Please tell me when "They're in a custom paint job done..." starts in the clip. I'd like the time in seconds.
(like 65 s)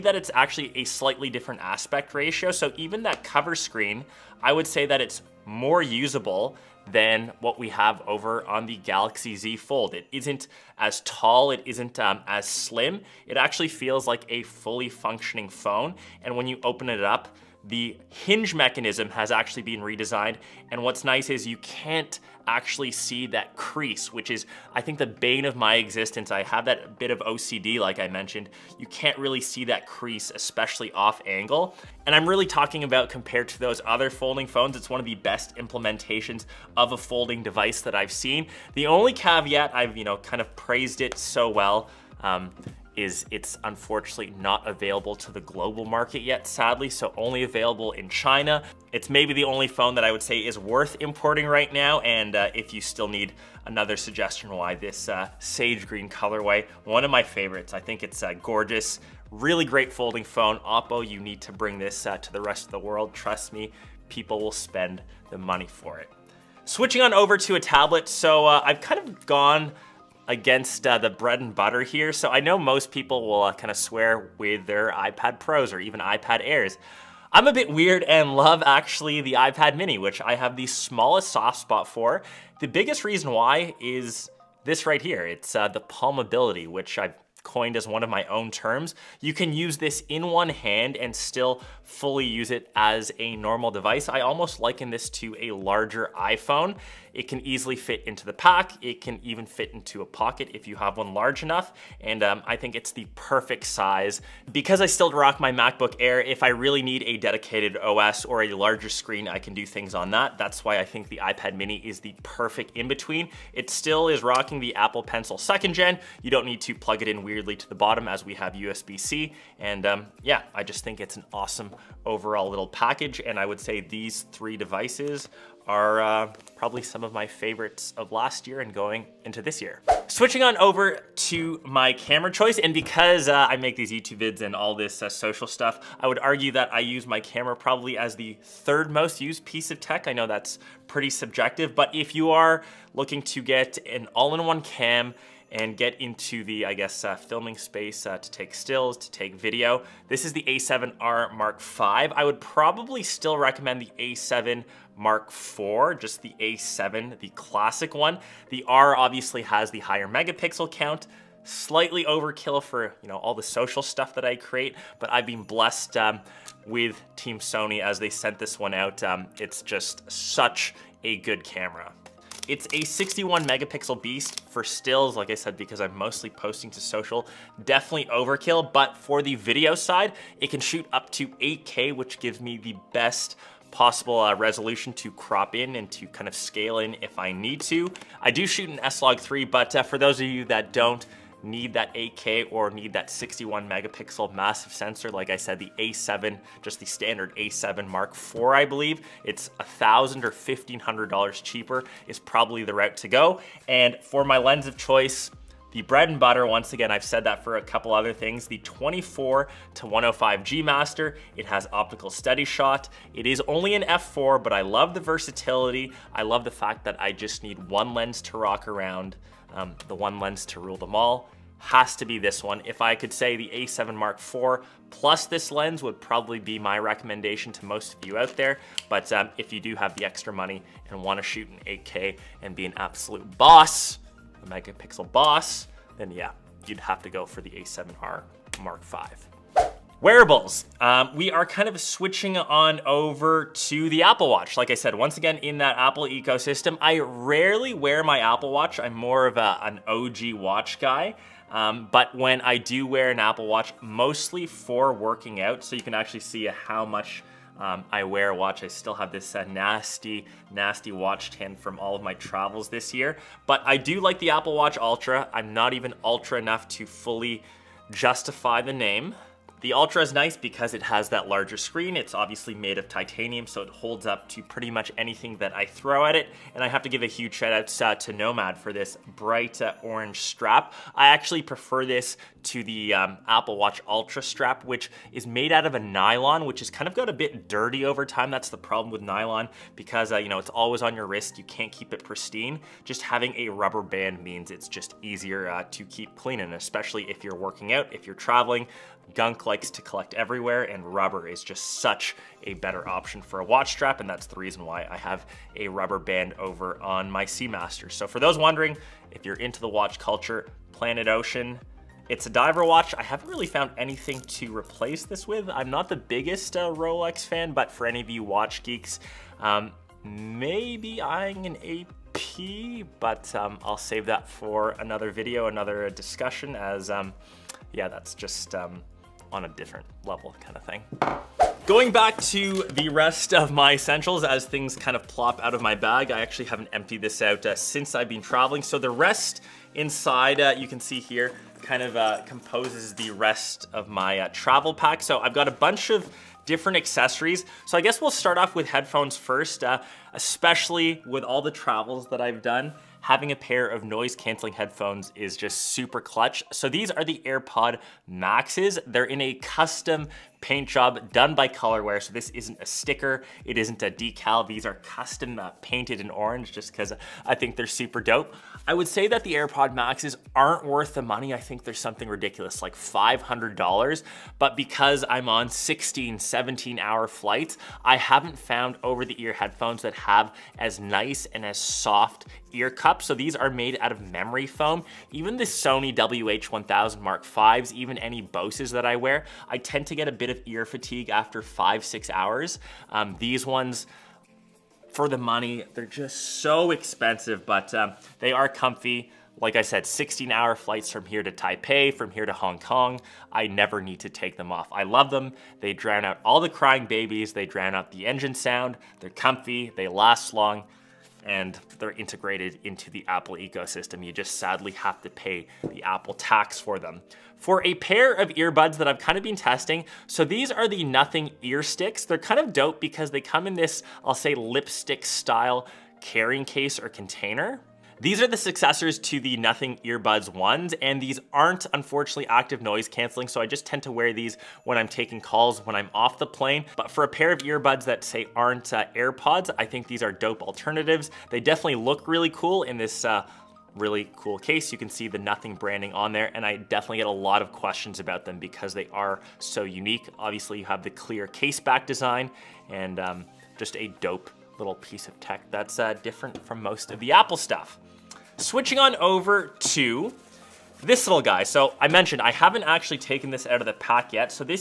358 s.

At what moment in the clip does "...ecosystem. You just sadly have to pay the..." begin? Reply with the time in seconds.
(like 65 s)
413 s.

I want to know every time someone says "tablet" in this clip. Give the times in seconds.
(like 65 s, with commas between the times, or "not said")
67 s.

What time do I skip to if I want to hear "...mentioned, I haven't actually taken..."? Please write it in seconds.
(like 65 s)
461 s.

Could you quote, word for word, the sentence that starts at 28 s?
You can't really see that crease, especially off angle.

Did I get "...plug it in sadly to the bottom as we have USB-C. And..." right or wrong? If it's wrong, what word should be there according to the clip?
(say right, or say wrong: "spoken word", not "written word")
wrong: "weirdly", not "sadly".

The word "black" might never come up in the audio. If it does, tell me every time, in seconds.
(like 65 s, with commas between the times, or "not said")
not said.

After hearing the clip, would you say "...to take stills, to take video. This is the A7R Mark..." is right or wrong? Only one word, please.
right.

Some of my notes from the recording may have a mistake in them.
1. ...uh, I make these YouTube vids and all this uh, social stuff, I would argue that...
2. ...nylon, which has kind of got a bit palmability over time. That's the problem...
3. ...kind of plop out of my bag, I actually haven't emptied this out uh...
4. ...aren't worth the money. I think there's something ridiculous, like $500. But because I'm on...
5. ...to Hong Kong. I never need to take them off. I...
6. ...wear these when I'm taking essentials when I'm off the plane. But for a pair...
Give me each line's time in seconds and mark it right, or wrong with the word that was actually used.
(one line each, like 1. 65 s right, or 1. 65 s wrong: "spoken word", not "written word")
1. 133 s right
2. 285 s wrong: "dirty", not "palmability"
3. 334 s right
4. 370 s right
5. 402 s right
6. 433 s wrong: "calls", not "essentials".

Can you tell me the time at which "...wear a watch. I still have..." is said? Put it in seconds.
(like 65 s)
258 s.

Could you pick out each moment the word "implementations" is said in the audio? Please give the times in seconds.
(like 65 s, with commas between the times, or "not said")
35 s.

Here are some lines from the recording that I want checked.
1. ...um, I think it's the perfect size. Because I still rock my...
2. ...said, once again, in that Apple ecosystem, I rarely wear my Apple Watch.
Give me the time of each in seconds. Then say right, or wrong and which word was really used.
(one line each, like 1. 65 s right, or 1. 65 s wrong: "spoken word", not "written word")
1. 102 s right
2. 244 s right.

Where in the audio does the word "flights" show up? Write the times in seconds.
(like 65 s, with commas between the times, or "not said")
377 s, 400 s.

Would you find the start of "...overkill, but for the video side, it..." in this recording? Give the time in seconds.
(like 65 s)
178 s.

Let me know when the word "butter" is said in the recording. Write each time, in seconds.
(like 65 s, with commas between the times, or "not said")
71 s, 206 s.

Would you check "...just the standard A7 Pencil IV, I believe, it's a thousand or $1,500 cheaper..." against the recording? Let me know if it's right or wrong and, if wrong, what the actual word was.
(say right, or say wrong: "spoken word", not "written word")
wrong: "Mark", not "Pencil".